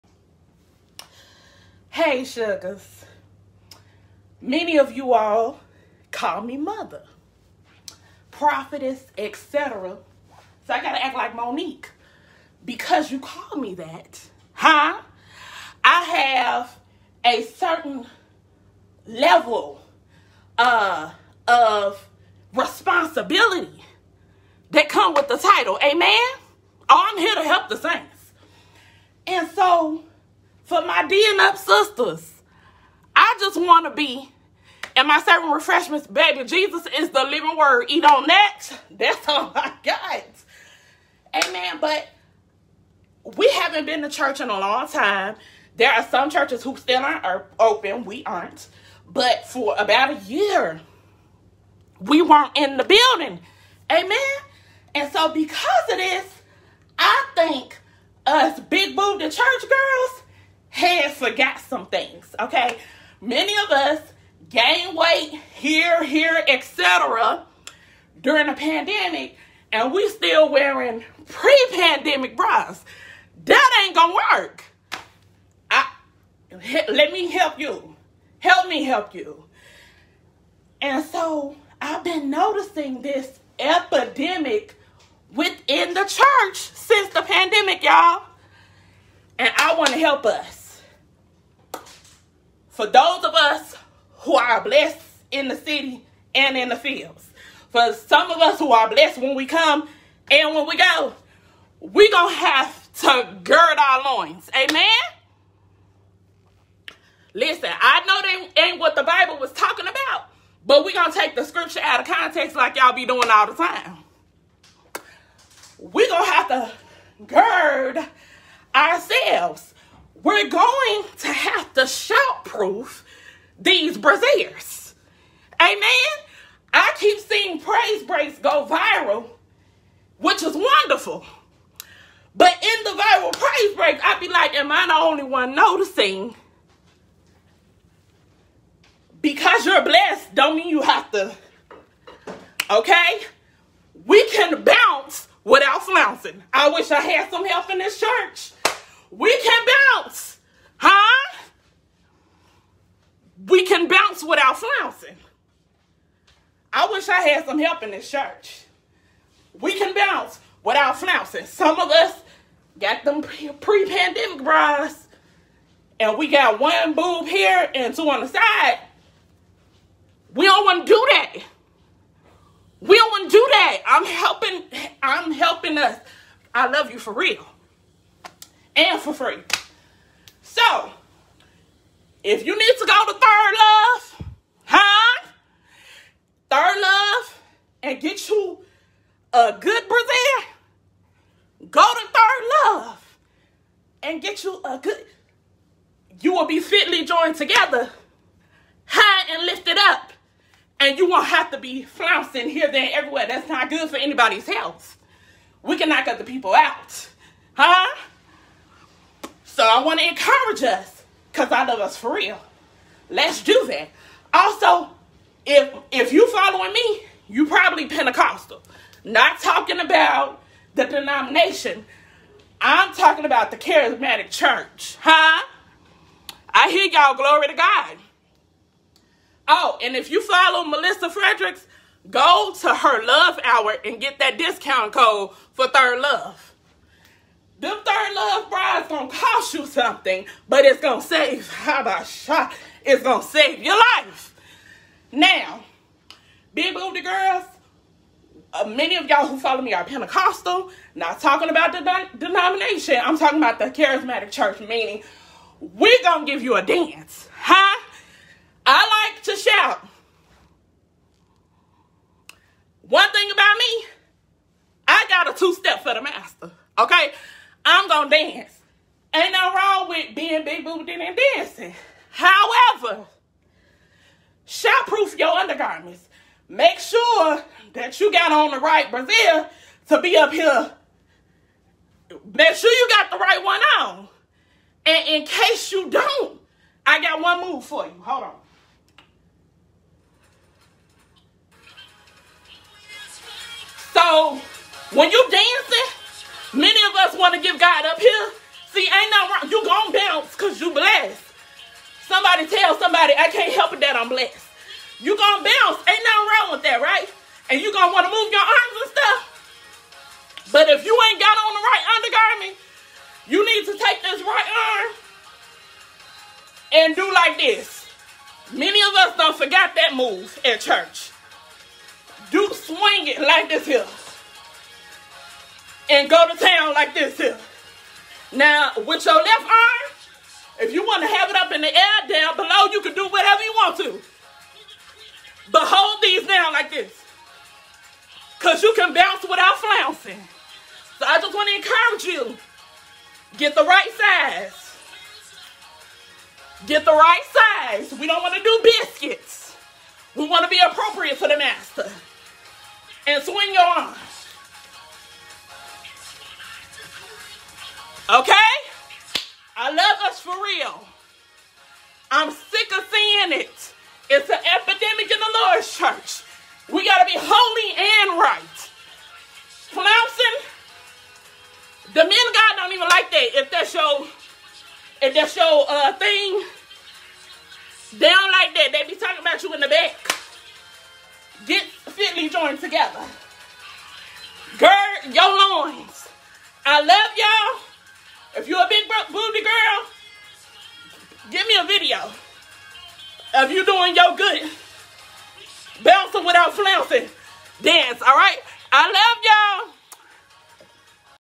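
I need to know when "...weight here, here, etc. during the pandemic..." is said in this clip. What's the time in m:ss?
1:04.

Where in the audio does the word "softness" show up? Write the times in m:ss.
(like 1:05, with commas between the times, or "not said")
not said.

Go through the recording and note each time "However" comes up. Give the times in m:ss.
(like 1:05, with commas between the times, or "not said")
4:32.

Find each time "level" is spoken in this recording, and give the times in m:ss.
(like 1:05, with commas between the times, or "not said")
0:19.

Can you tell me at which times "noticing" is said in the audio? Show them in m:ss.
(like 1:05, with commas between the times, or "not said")
1:22, 2:15.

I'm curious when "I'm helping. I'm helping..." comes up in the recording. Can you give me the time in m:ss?
2:53.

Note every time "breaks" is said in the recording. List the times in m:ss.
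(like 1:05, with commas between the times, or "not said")
2:08, 2:13.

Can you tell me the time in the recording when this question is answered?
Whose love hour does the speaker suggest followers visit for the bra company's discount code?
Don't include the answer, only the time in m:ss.
3:50.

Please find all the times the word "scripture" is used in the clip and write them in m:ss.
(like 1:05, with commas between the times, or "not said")
1:51.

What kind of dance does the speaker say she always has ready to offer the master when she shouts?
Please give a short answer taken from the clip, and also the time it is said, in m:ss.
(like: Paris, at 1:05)
a two step, at 4:25.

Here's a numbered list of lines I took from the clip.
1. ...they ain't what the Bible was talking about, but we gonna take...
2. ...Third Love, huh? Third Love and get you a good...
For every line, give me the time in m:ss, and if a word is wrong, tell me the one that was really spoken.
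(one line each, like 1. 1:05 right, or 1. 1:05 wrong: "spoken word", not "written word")
1. 1:48 right
2. 3:03 right.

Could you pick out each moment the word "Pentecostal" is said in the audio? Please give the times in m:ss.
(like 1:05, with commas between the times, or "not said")
3:37, 4:09.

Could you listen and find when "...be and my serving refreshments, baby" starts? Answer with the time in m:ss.
0:33.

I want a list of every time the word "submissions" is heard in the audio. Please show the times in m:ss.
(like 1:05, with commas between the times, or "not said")
not said.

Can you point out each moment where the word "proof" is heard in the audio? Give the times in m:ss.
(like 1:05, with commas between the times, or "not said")
2:02, 4:34.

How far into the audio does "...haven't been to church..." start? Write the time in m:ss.
0:43.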